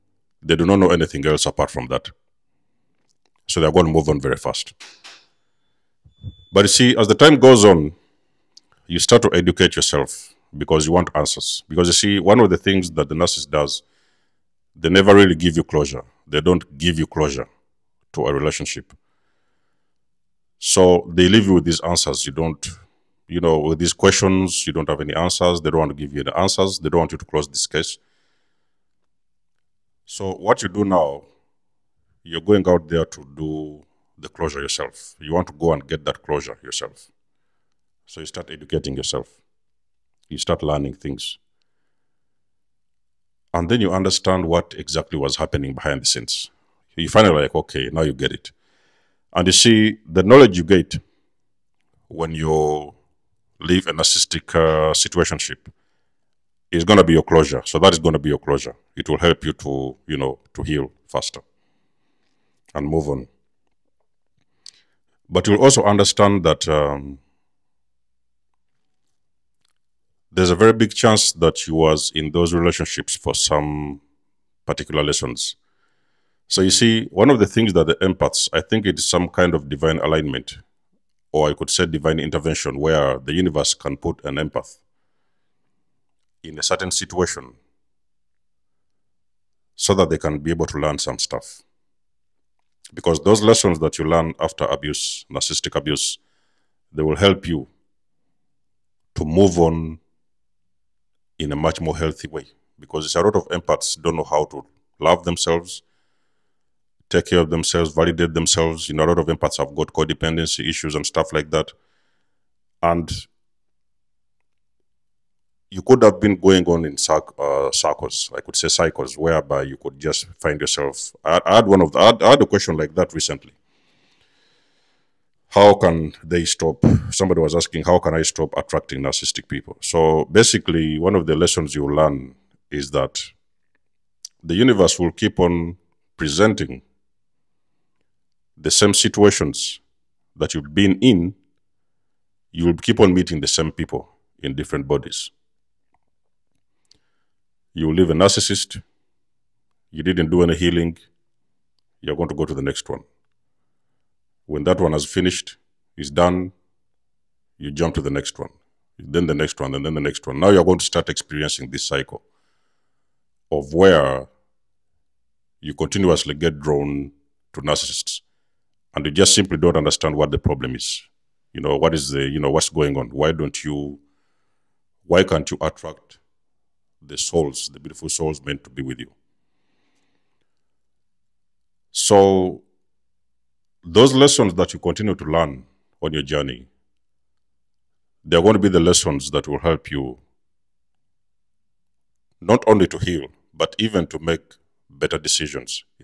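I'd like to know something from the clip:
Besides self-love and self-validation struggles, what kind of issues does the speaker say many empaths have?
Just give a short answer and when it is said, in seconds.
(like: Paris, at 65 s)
Codependency issues, at 109 s.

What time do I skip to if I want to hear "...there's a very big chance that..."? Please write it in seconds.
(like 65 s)
70 s.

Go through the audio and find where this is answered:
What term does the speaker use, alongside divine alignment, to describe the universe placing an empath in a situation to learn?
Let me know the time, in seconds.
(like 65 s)
81 s.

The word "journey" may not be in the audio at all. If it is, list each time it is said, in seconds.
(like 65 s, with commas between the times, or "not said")
186 s.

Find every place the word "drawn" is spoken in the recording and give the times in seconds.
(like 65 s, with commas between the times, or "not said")
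166 s.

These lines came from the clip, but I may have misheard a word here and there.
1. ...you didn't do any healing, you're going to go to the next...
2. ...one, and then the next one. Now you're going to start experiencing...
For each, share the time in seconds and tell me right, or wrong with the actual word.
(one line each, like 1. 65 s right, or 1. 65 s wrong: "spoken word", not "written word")
1. 149 s right
2. 159 s right.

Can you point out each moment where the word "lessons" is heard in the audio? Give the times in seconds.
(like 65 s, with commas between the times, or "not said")
75 s, 93 s, 131 s, 184 s, 188 s.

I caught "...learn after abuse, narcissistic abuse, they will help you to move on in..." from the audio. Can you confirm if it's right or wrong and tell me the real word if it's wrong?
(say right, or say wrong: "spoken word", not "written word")
right.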